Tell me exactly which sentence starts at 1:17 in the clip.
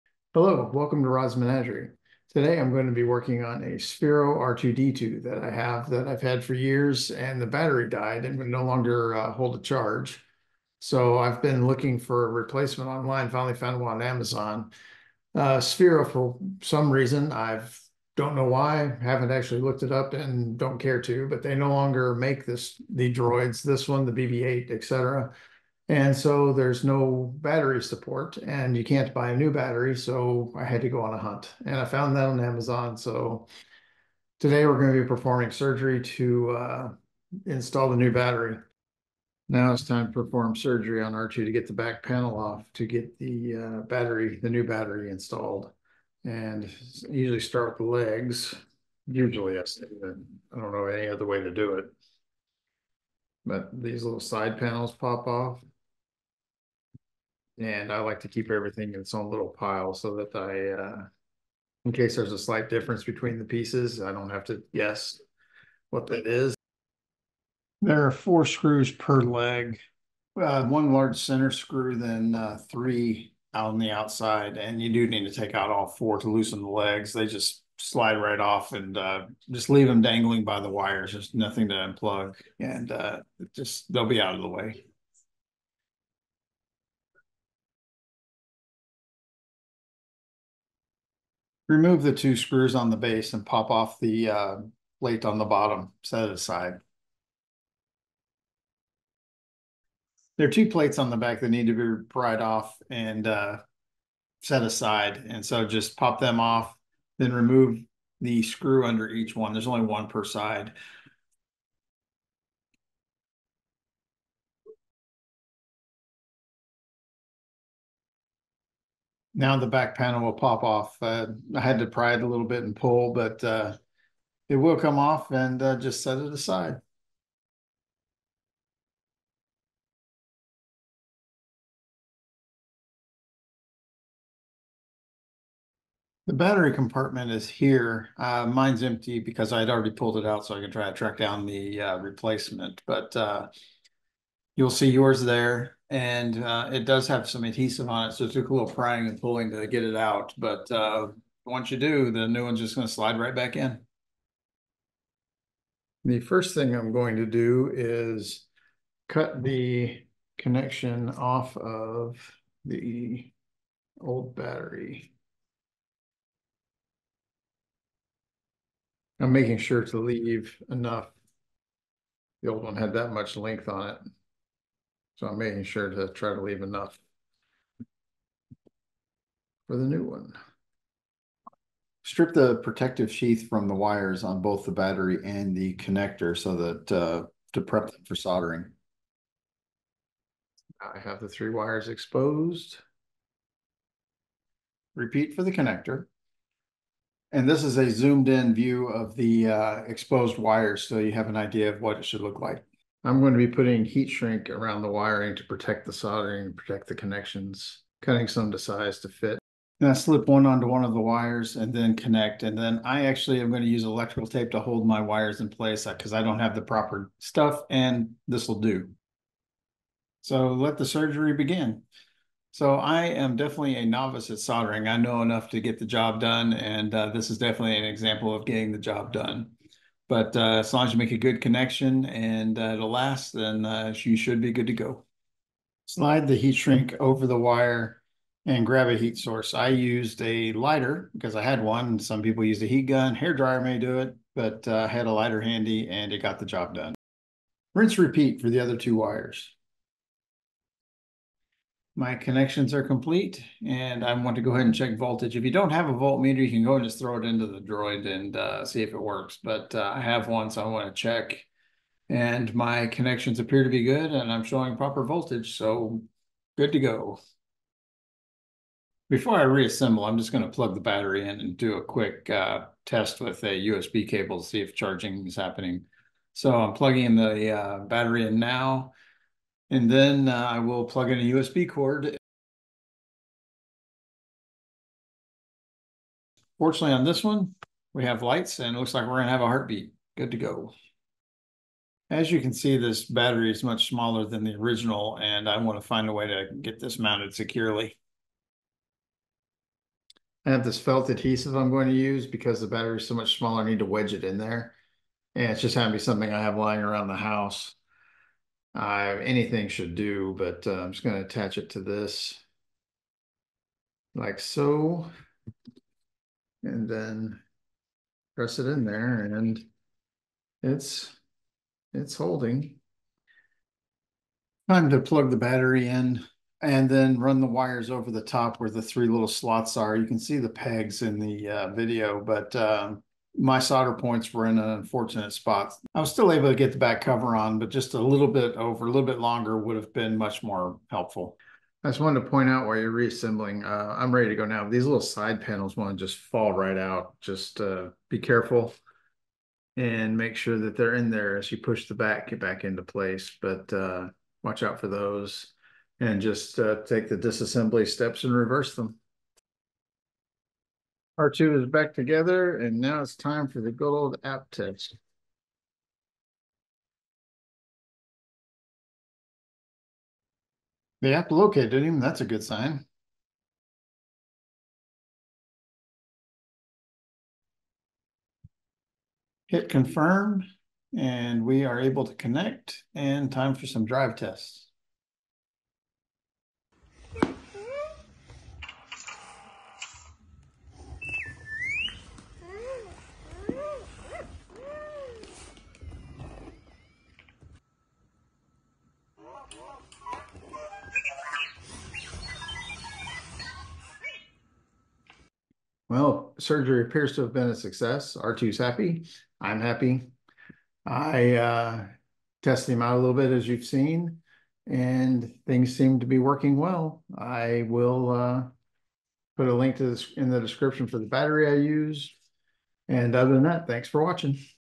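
They just slide right off and uh, just leave them dangling by the wires.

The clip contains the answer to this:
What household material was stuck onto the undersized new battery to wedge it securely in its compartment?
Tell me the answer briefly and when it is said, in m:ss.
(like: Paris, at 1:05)
Felt adhesive, at 5:00.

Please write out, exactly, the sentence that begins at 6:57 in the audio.
I will uh, put a link to this in the description for the battery I used.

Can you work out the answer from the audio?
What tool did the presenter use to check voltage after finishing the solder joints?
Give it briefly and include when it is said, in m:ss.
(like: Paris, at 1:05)
Voltmeter, at 4:15.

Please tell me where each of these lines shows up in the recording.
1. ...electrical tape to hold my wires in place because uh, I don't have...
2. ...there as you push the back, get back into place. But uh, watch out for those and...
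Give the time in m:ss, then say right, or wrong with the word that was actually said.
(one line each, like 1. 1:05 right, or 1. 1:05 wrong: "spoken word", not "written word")
1. 3:33 right
2. 5:51 right.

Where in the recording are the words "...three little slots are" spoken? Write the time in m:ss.
5:28.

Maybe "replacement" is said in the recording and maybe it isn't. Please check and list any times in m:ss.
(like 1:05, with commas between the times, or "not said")
0:12, 2:21.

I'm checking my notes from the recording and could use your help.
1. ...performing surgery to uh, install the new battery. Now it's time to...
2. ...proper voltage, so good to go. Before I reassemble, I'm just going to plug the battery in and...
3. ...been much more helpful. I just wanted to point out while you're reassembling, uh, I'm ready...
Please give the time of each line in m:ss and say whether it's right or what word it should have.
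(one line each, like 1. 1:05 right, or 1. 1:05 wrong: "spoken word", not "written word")
1. 0:35 right
2. 4:24 right
3. 5:39 right.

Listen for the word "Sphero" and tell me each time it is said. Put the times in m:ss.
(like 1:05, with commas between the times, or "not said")
0:03, 0:15.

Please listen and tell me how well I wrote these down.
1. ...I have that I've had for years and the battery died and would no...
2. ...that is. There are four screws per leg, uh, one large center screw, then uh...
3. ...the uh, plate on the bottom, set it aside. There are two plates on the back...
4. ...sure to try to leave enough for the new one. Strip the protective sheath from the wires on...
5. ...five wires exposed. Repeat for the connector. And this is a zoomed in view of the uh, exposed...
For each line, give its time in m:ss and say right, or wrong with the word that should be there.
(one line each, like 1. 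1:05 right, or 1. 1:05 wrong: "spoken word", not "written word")
1. 0:05 right
2. 1:06 right
3. 1:34 right
4. 2:55 right
5. 3:11 wrong: "three", not "five".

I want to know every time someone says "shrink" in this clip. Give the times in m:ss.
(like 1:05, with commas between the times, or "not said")
3:24, 3:56.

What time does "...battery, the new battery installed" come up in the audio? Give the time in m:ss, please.
0:43.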